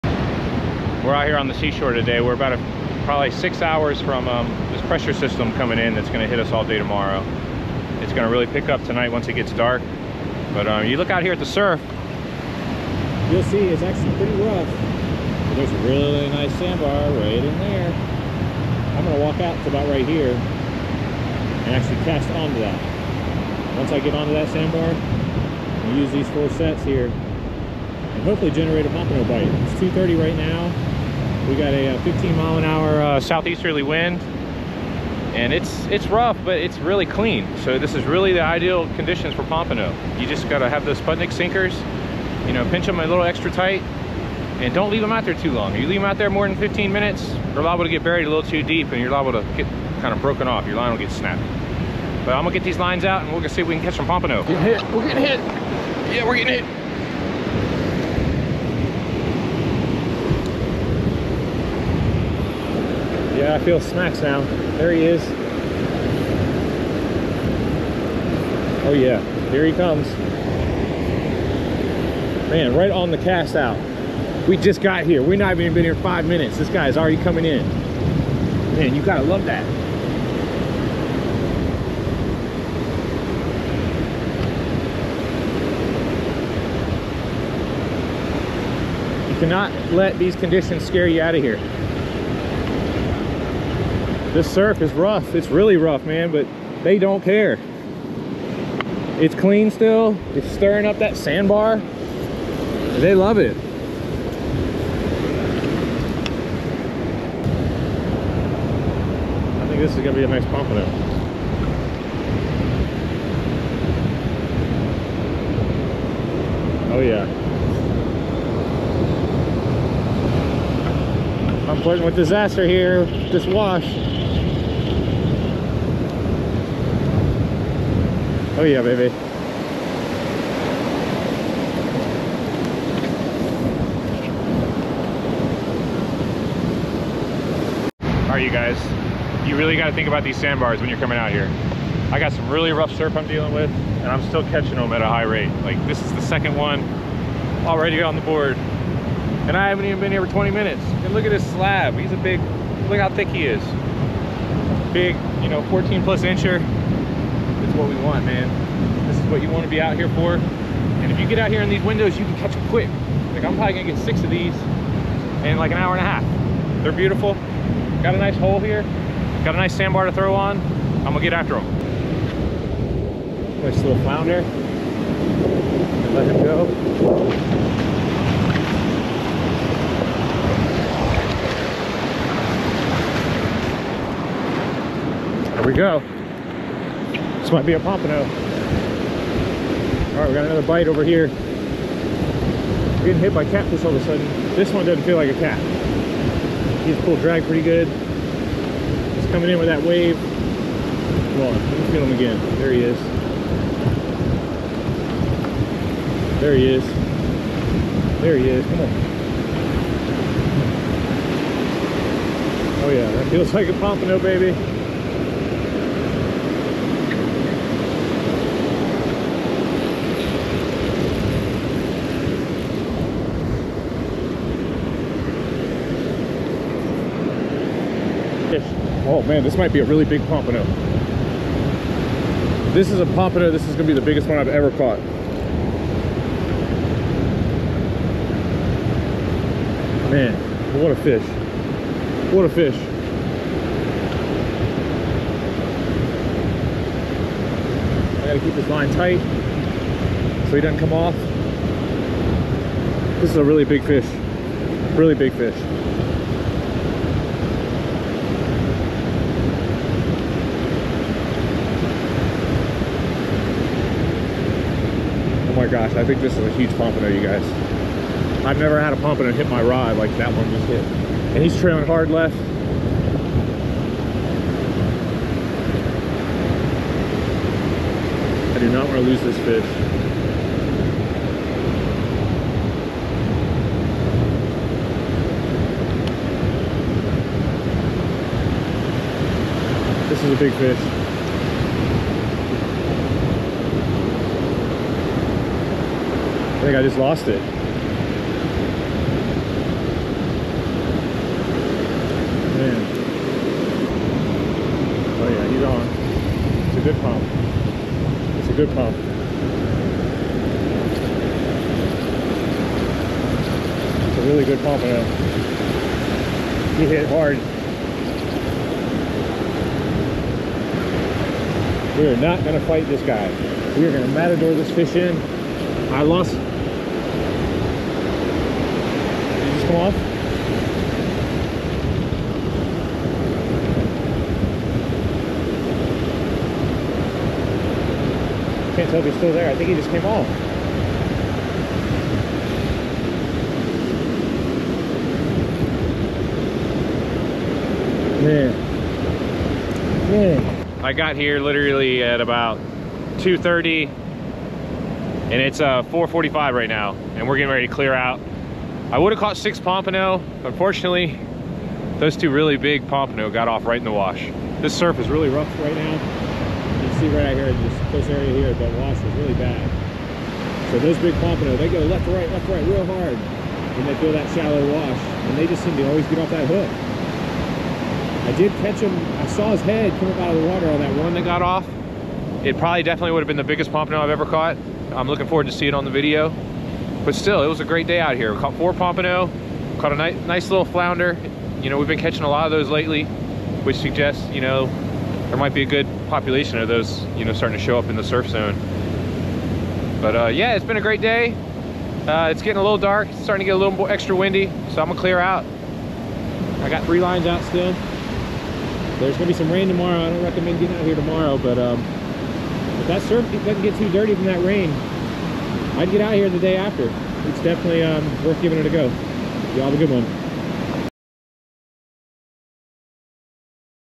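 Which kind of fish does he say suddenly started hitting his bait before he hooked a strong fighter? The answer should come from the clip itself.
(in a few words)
catfish.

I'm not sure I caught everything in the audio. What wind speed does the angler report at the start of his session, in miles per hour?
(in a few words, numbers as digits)
15.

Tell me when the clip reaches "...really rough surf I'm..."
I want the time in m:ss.
2:22.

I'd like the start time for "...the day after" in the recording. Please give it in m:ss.
6:56.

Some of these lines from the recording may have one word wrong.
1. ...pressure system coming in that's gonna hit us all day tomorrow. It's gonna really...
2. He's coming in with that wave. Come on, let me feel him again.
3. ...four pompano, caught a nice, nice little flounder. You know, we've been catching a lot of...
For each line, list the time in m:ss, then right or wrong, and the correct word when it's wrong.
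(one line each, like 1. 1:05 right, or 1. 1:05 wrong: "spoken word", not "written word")
1. 0:04 right
2. 3:17 right
3. 6:28 right.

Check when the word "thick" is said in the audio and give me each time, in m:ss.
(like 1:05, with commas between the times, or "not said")
2:33.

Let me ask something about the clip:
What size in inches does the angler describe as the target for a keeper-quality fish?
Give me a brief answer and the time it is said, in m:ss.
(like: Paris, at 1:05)
14 plus, at 2:35.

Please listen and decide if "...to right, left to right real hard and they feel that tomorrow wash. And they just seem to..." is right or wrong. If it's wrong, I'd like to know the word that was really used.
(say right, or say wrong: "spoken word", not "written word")
wrong: "shallow", not "tomorrow".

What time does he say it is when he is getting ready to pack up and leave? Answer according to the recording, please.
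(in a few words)
4:45.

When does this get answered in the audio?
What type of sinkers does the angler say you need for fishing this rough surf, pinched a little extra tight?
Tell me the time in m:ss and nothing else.
0:40.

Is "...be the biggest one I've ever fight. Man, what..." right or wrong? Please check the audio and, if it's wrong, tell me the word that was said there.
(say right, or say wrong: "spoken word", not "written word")
wrong: "caught", not "fight".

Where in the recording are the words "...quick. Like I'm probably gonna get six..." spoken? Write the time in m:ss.
2:42.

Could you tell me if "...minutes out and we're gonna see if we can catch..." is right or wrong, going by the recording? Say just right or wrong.
wrong.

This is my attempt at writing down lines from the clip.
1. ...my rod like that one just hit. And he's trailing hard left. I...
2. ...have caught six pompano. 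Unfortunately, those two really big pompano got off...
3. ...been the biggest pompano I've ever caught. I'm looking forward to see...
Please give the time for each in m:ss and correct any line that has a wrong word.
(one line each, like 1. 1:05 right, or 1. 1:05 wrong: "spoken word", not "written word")
1. 4:29 right
2. 5:59 right
3. 6:23 right.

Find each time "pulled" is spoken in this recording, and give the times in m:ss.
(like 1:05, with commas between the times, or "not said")
3:17.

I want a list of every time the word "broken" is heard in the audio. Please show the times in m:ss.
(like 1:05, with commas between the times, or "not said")
0:50.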